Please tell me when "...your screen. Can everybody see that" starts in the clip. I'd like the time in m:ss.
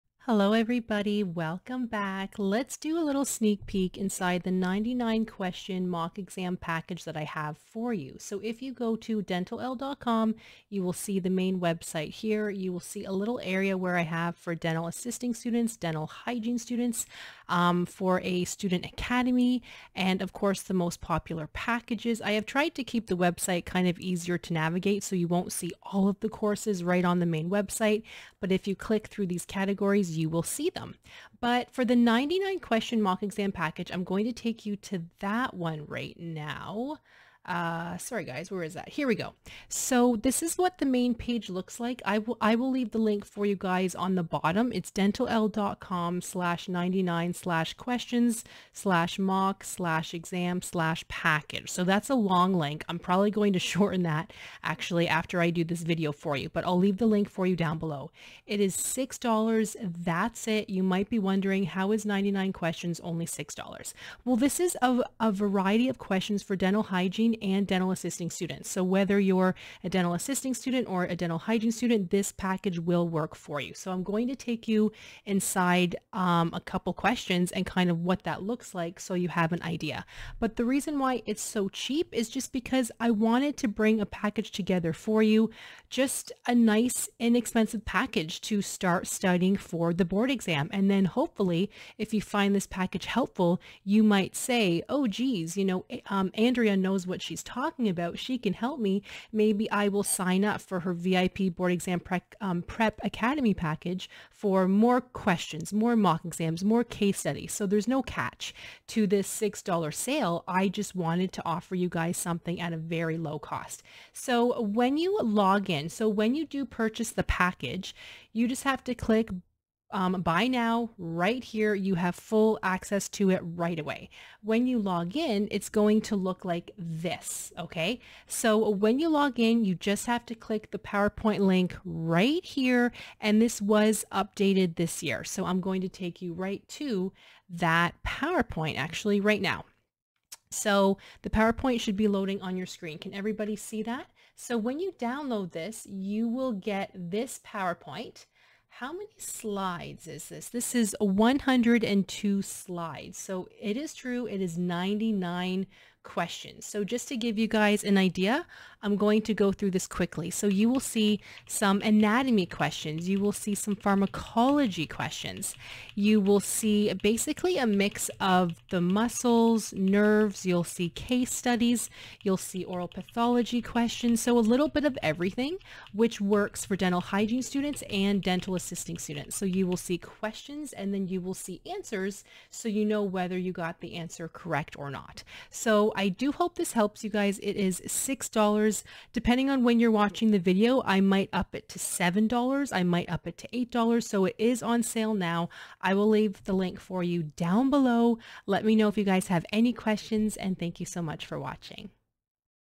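2:22.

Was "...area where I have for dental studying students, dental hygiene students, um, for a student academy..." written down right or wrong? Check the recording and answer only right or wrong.
wrong.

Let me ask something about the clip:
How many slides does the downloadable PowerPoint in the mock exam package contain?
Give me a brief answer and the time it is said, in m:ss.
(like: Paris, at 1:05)
102, at 2:30.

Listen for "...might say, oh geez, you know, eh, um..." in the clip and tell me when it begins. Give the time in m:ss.
1:34.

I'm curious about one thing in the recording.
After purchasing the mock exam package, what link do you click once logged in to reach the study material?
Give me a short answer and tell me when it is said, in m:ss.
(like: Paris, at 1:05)
PowerPoint link, at 2:10.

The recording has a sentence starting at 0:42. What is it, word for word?
I will, I will leave the link for you guys on the bottom.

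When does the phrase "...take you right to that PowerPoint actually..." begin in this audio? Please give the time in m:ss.
2:15.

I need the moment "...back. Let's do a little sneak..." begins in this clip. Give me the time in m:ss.
0:01.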